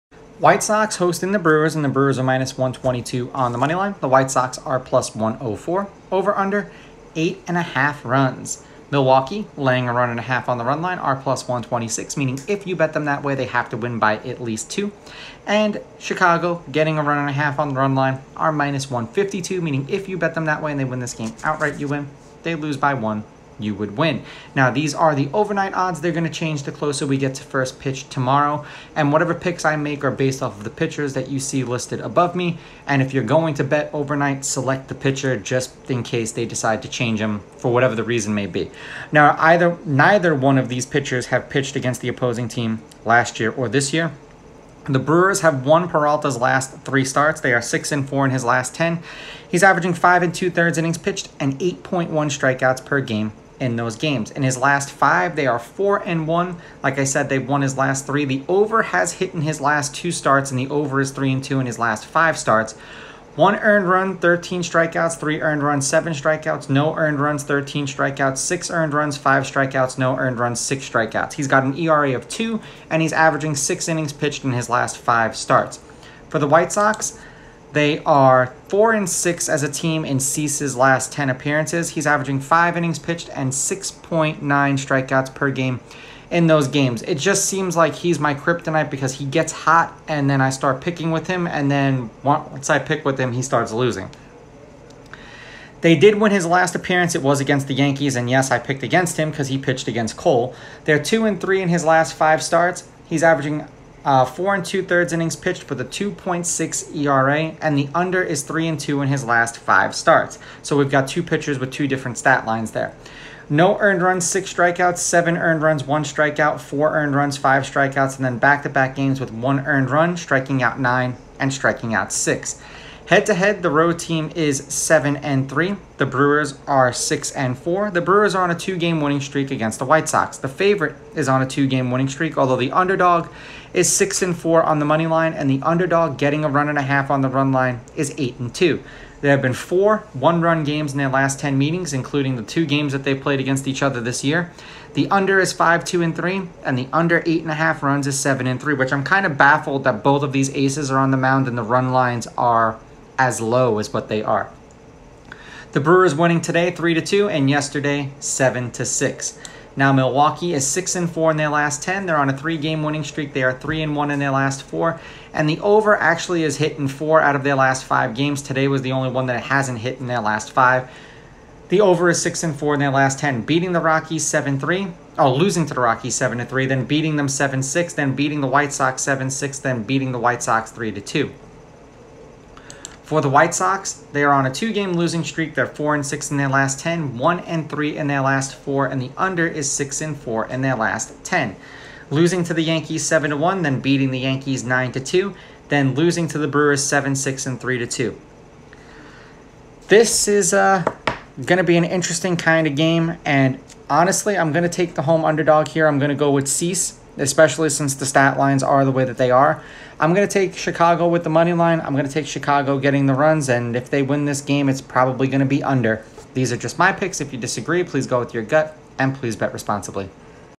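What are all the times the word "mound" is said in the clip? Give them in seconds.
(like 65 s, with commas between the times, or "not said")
151 s.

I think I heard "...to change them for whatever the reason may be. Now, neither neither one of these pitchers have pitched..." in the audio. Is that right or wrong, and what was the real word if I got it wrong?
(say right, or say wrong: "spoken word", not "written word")
wrong: "either", not "neither".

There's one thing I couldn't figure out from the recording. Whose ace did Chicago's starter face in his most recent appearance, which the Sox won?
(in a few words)
Cole.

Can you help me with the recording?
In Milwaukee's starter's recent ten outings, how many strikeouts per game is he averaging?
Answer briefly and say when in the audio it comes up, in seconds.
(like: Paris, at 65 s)
8.1, at 51 s.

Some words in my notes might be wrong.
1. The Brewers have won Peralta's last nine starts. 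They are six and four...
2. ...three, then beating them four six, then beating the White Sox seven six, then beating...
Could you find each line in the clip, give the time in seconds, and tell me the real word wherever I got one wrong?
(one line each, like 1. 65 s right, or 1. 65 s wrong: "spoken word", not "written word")
1. 44 s wrong: "three", not "nine"
2. 176 s wrong: "seven", not "four".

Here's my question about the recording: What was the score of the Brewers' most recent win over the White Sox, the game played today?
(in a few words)
3 to 2.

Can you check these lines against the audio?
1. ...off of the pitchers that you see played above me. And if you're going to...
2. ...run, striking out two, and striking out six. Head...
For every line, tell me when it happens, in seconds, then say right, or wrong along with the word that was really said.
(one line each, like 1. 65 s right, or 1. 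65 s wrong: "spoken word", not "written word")
1. 30 s wrong: "listed", not "played"
2. 119 s wrong: "nine", not "two".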